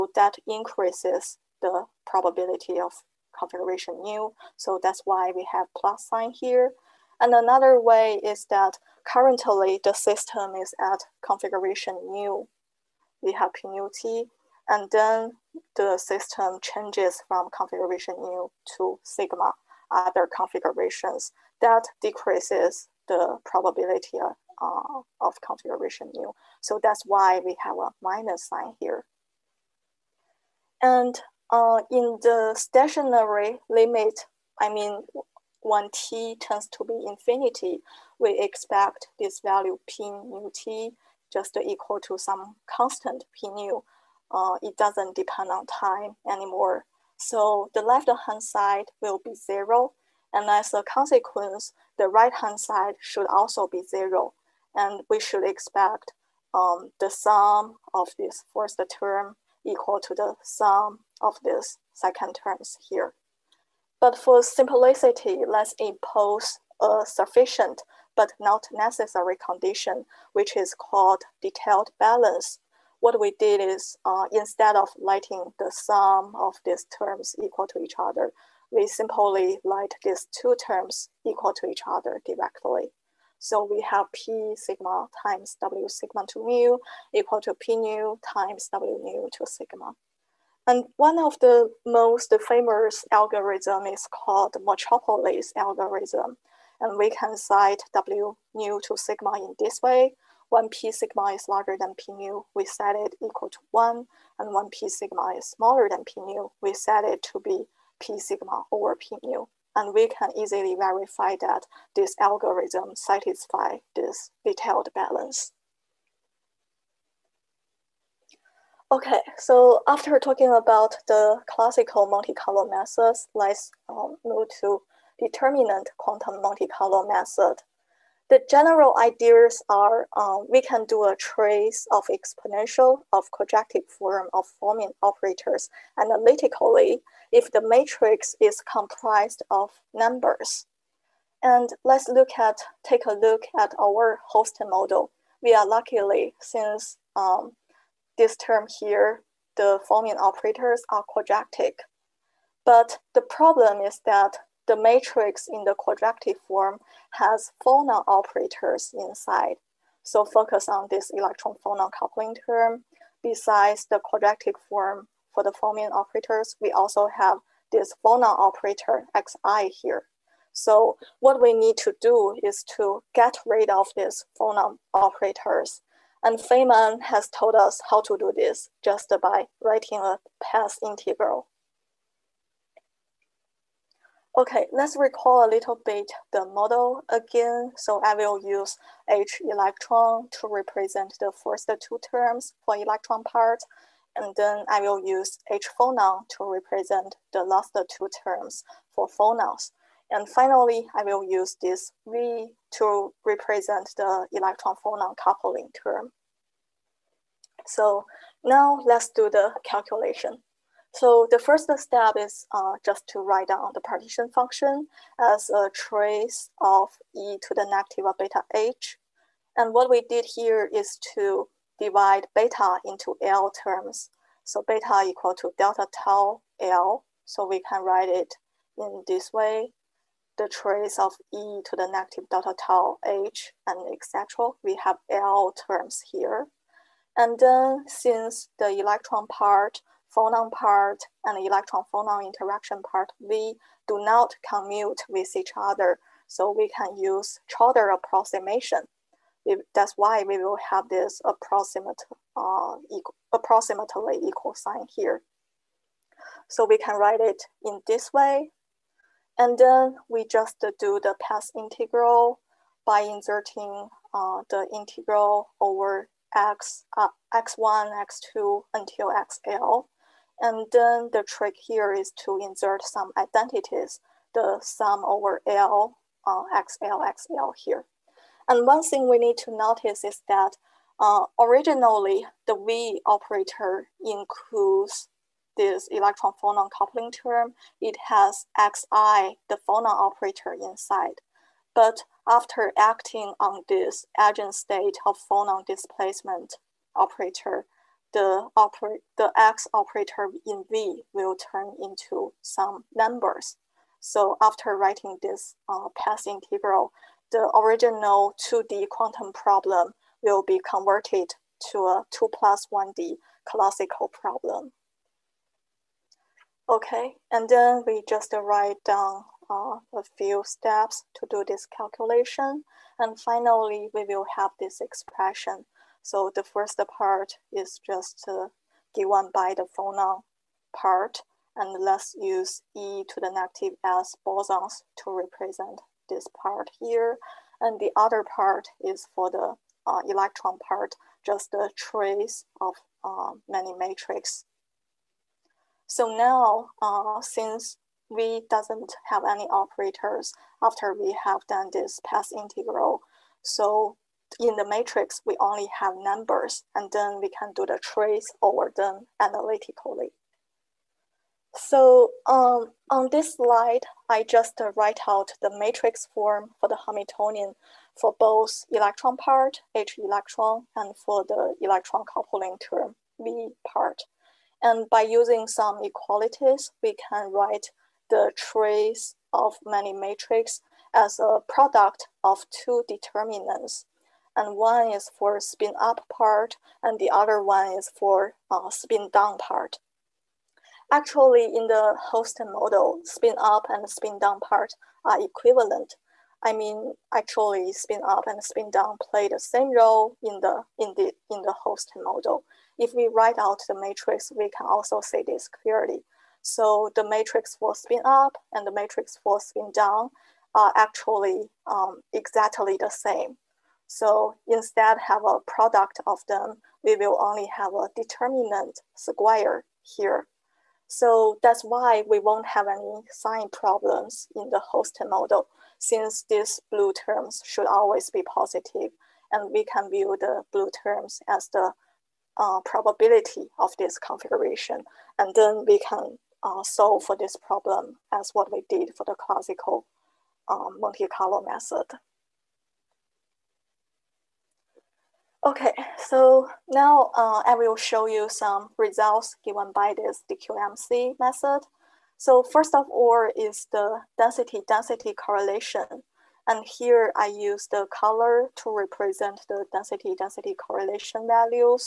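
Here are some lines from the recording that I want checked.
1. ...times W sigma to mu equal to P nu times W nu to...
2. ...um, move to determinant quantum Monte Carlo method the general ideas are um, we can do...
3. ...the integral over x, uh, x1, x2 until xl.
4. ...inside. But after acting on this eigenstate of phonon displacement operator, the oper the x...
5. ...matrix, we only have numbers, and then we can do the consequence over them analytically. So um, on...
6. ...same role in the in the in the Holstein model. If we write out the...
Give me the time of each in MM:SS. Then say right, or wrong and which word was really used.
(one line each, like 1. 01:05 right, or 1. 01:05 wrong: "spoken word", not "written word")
1. 01:25 right
2. 02:03 right
3. 04:24 right
4. 04:50 right
5. 05:54 wrong: "trace", not "consequence"
6. 06:39 right.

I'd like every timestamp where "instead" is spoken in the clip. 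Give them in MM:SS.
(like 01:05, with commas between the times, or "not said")
01:14, 06:54.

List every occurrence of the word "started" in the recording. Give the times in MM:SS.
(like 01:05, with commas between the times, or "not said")
not said.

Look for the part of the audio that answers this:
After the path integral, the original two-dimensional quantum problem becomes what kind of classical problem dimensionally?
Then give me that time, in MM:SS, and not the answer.
05:12.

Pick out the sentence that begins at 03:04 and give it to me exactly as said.
Okay, let's recall a little bit the model again.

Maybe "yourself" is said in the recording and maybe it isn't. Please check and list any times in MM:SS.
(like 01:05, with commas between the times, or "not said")
not said.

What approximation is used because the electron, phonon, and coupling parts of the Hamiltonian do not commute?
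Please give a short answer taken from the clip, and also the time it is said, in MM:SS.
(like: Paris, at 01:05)
Trotter approximation, at 04:07.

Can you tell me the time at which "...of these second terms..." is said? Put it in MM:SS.
01:01.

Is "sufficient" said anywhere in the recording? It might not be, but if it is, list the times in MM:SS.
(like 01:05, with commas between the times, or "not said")
01:07.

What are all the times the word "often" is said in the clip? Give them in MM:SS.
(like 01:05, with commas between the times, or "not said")
not said.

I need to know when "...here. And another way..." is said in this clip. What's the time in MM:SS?
00:06.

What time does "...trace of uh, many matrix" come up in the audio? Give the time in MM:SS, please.
05:41.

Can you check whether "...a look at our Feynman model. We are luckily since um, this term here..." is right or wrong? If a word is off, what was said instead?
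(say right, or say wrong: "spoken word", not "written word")
wrong: "Holstein", not "Feynman".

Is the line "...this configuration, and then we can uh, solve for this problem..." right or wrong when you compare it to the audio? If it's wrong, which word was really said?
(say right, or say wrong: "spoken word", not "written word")
right.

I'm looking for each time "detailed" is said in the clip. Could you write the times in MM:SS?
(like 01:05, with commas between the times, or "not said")
01:11, 01:54.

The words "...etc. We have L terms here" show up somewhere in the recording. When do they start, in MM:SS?
03:53.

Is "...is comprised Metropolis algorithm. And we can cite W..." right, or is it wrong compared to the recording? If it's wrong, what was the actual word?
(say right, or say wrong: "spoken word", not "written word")
wrong: "called", not "comprised".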